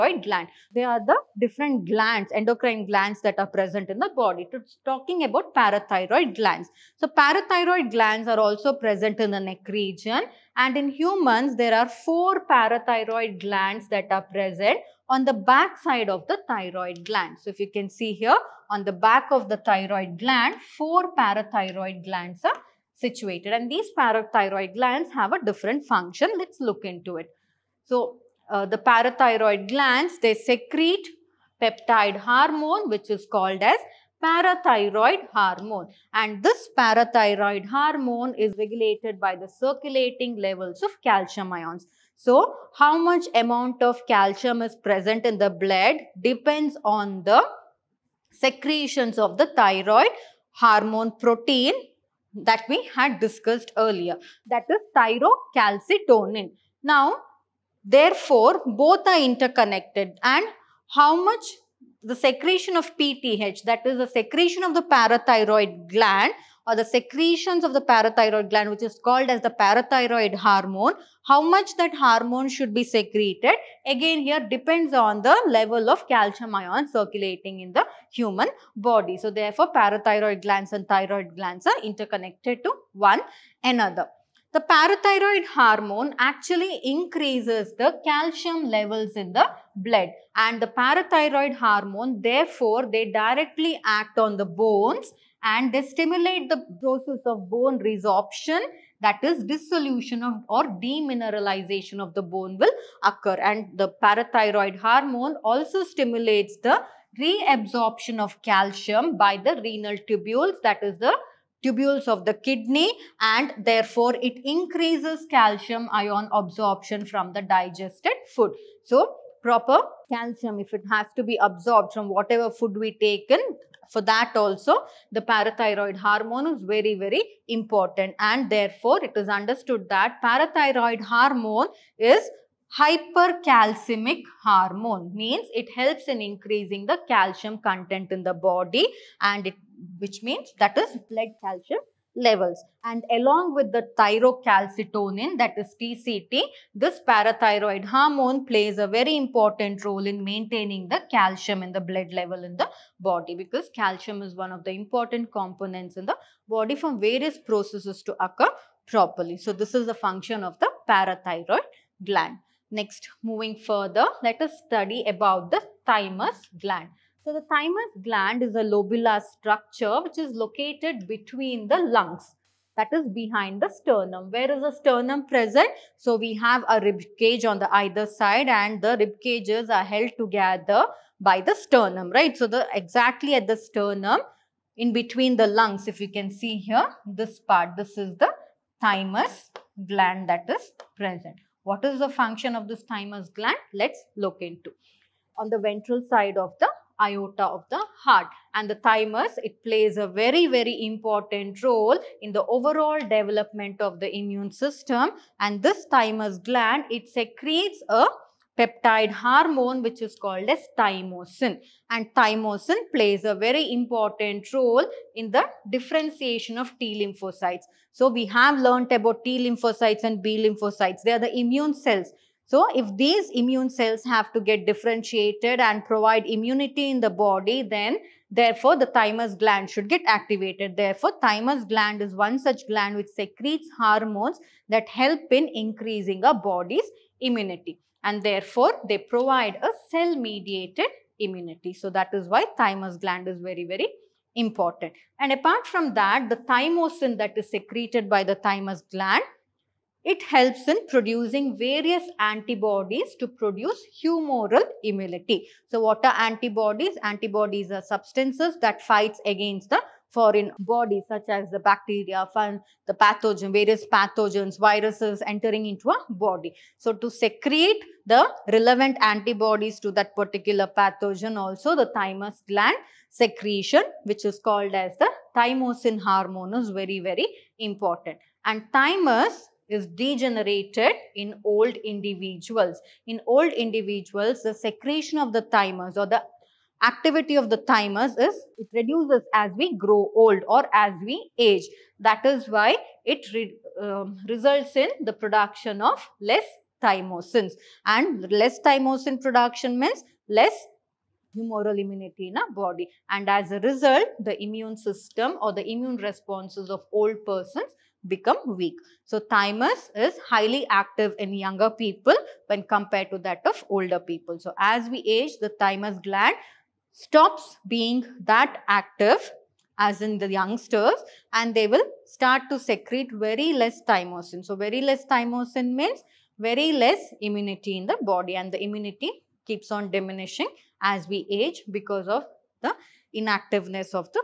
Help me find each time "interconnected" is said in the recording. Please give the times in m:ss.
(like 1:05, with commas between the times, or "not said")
0:59, 1:21.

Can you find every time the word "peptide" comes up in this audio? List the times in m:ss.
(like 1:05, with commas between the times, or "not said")
0:31, 3:28.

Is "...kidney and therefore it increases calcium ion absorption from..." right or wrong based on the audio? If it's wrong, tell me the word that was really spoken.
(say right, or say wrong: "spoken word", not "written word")
right.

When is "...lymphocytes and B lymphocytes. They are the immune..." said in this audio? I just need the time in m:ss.
3:39.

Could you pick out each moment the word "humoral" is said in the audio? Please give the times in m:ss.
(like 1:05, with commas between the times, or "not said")
4:14, 5:01.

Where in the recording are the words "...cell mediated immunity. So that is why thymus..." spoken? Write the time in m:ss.
3:59.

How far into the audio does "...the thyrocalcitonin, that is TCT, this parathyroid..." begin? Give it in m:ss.
2:23.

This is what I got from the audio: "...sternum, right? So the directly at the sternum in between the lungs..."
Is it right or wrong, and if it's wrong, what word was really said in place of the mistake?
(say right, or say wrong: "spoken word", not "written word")
wrong: "exactly", not "directly".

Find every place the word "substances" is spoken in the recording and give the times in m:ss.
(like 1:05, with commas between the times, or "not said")
4:17.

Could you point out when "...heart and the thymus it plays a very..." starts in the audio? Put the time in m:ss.
3:18.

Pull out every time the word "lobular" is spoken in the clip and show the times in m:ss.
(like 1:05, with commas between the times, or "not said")
2:48.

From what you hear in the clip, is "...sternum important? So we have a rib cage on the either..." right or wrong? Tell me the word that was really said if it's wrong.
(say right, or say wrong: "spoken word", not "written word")
wrong: "present", not "important".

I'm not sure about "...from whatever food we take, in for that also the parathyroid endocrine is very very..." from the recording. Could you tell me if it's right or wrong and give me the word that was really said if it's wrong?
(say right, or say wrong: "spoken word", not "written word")
wrong: "hormone", not "endocrine".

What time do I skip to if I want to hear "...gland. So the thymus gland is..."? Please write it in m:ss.
2:46.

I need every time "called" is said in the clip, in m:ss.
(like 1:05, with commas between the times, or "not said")
0:33, 1:09, 3:30, 4:34.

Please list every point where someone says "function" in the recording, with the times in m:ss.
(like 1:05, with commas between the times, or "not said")
0:25, 2:39, 3:12.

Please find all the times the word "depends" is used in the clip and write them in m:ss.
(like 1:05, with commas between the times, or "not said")
0:46, 1:14.